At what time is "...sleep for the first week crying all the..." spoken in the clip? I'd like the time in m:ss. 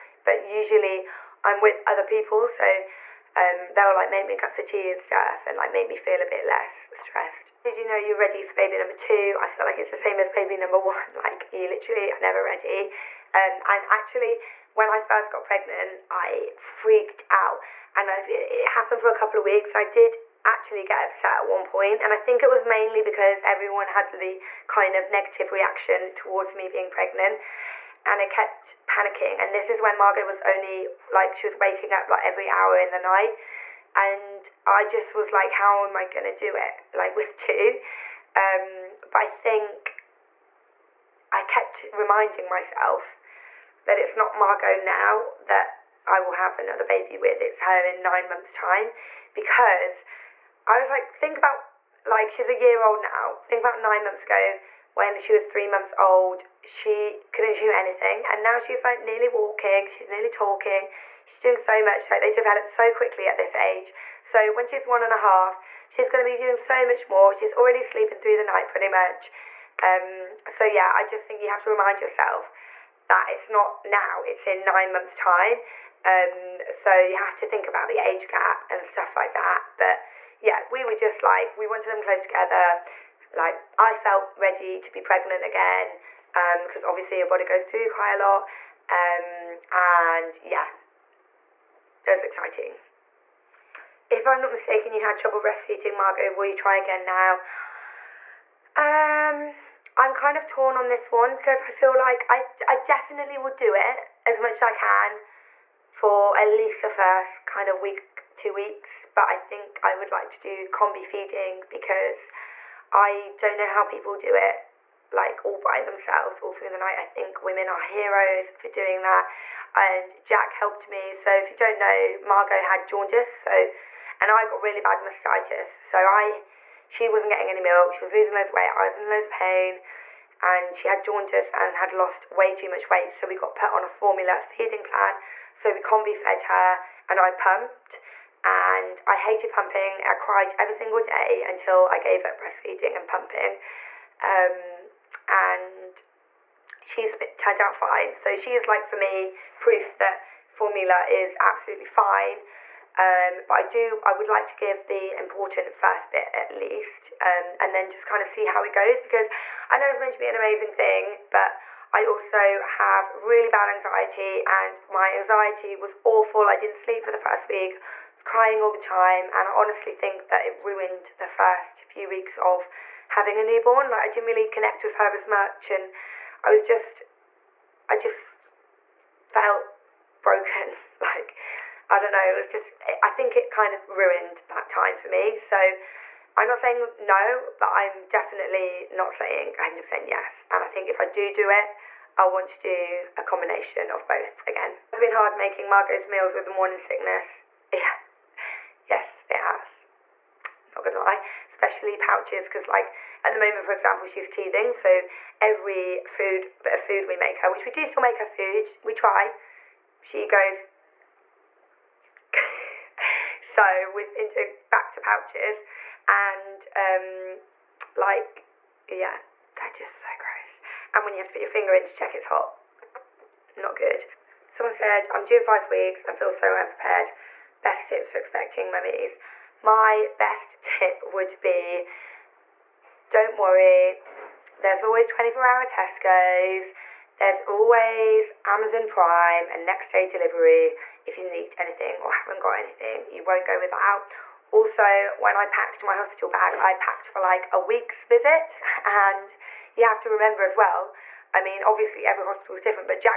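2:46.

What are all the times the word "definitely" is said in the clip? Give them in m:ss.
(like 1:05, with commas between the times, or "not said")
1:42, 3:08.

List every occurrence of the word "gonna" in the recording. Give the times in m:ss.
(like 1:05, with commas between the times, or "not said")
0:36, 1:06, 3:20.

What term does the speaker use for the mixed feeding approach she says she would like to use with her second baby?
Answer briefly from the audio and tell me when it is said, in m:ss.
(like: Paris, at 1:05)
combi feeding, at 1:50.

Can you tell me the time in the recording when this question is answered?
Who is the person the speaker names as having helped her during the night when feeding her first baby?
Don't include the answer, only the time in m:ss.
2:00.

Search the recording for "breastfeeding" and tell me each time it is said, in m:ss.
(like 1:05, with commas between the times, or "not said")
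1:35, 2:22.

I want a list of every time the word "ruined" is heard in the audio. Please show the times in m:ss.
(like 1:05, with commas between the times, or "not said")
2:50, 3:03.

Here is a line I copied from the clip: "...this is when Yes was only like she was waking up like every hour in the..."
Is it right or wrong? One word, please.
wrong.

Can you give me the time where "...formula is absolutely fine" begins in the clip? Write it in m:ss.
2:30.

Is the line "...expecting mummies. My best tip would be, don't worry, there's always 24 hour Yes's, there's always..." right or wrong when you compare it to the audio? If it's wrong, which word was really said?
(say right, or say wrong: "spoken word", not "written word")
wrong: "Tesco", not "Yes".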